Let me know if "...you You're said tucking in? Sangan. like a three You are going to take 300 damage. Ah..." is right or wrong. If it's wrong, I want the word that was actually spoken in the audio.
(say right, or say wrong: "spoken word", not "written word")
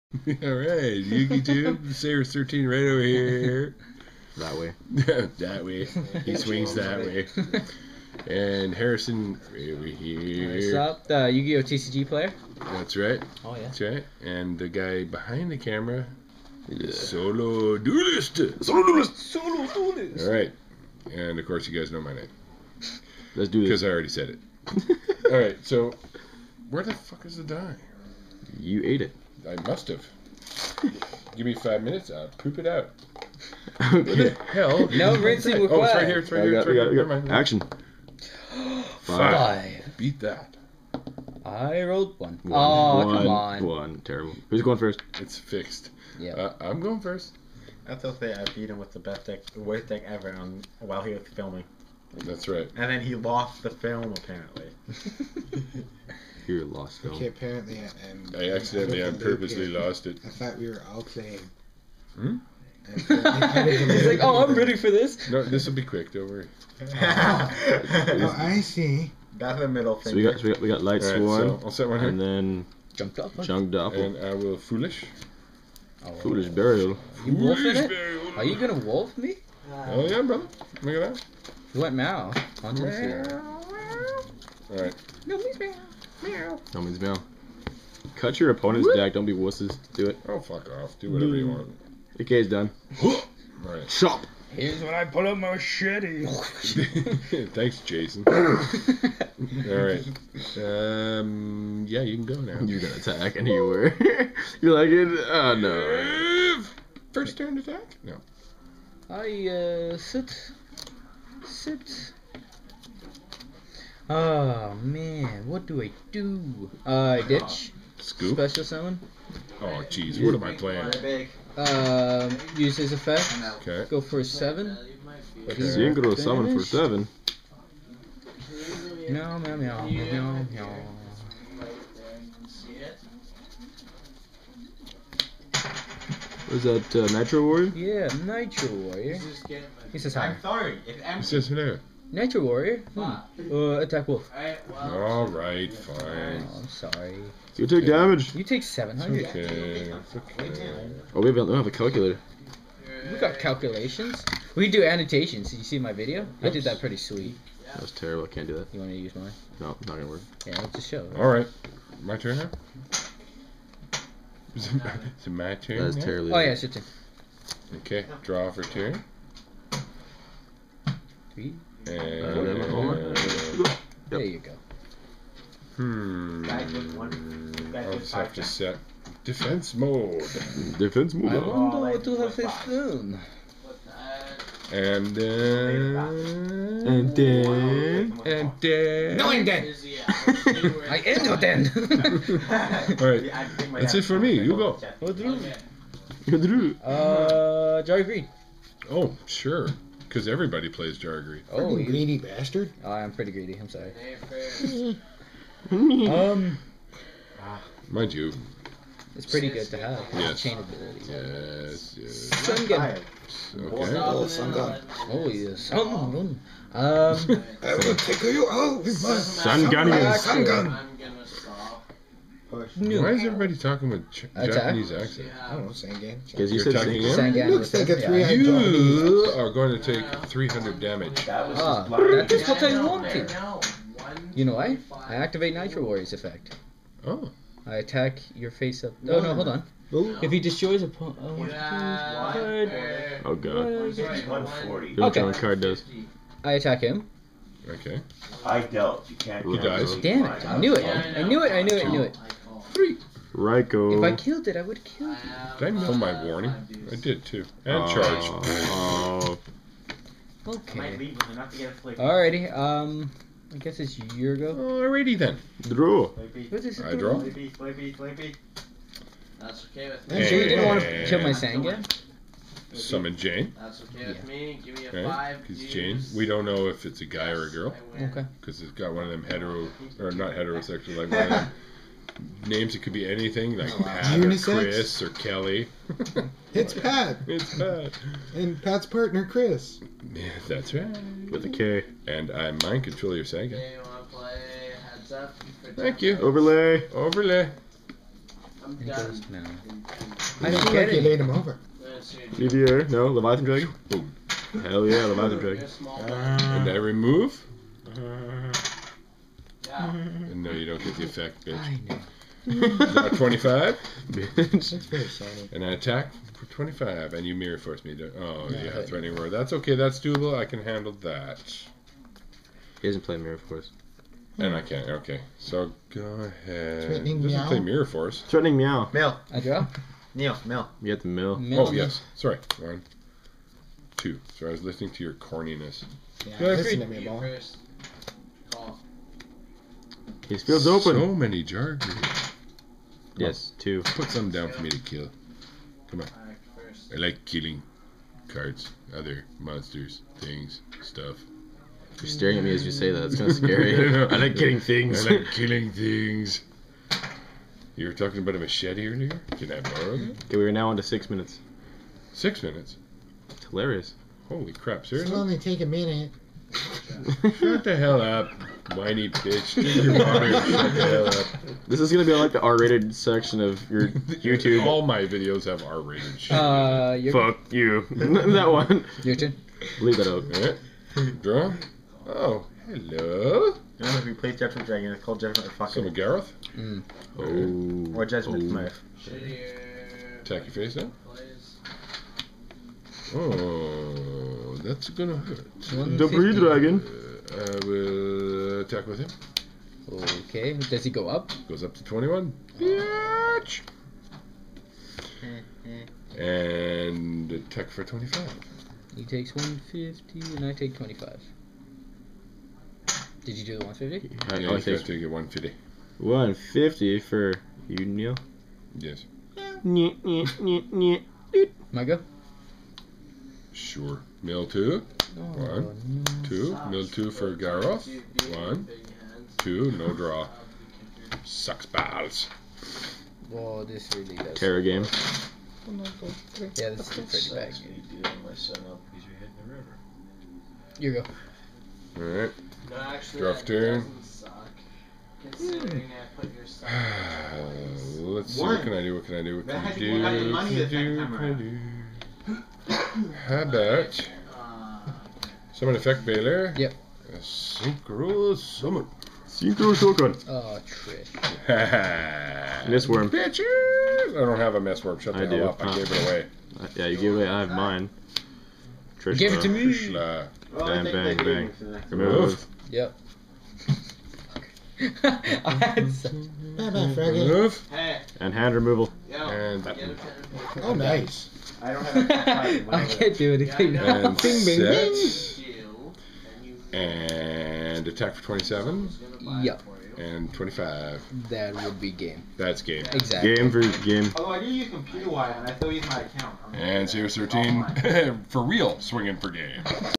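right.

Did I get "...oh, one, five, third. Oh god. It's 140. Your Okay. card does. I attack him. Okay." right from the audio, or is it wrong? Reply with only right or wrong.
wrong.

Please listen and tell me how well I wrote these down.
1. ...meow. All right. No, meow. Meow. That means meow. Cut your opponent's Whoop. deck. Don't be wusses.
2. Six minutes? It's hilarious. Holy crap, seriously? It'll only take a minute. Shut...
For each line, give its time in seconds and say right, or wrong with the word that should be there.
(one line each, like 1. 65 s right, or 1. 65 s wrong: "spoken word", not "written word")
1. 81 s right
2. 362 s right.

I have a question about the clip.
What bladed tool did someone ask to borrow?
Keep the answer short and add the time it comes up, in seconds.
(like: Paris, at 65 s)
a machete, at 358 s.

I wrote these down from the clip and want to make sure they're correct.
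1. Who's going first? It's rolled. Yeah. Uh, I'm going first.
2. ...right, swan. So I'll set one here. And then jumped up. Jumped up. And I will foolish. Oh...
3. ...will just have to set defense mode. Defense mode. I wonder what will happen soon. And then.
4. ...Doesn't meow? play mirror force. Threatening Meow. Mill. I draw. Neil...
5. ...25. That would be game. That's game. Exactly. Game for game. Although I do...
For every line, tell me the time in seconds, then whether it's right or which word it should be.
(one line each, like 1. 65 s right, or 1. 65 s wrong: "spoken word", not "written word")
1. 44 s wrong: "fixed", not "rolled"
2. 71 s right
3. 177 s right
4. 327 s right
5. 490 s right.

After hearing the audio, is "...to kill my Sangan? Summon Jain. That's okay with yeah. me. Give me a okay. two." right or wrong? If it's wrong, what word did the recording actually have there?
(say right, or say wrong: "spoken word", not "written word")
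wrong: "five", not "two".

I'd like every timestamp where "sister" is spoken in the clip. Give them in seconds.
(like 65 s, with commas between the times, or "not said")
not said.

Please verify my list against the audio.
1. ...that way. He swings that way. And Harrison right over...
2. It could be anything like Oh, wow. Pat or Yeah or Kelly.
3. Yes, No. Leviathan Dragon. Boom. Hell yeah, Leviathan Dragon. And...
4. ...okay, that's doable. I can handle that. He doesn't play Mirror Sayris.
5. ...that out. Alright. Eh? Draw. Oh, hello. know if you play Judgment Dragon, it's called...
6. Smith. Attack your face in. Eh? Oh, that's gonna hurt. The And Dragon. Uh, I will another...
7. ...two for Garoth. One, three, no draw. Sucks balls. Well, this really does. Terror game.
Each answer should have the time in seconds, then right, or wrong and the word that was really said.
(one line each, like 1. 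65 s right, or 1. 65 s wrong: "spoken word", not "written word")
1. 4 s right
2. 282 s wrong: "Chris", not "Yeah"
3. 301 s right
4. 319 s wrong: "Force", not "Sayris"
5. 379 s right
6. 388 s wrong: "Blue", not "And"
7. 426 s wrong: "two", not "three".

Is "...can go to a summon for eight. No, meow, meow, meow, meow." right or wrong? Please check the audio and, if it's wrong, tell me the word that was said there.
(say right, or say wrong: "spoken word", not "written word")
wrong: "seven", not "eight".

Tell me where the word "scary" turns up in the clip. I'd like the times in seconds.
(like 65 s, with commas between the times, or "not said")
353 s.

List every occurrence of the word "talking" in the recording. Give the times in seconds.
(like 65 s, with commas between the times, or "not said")
223 s, 357 s.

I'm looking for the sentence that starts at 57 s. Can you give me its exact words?
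Okay, apparently, uh, um, I accidentally and purposely lost it.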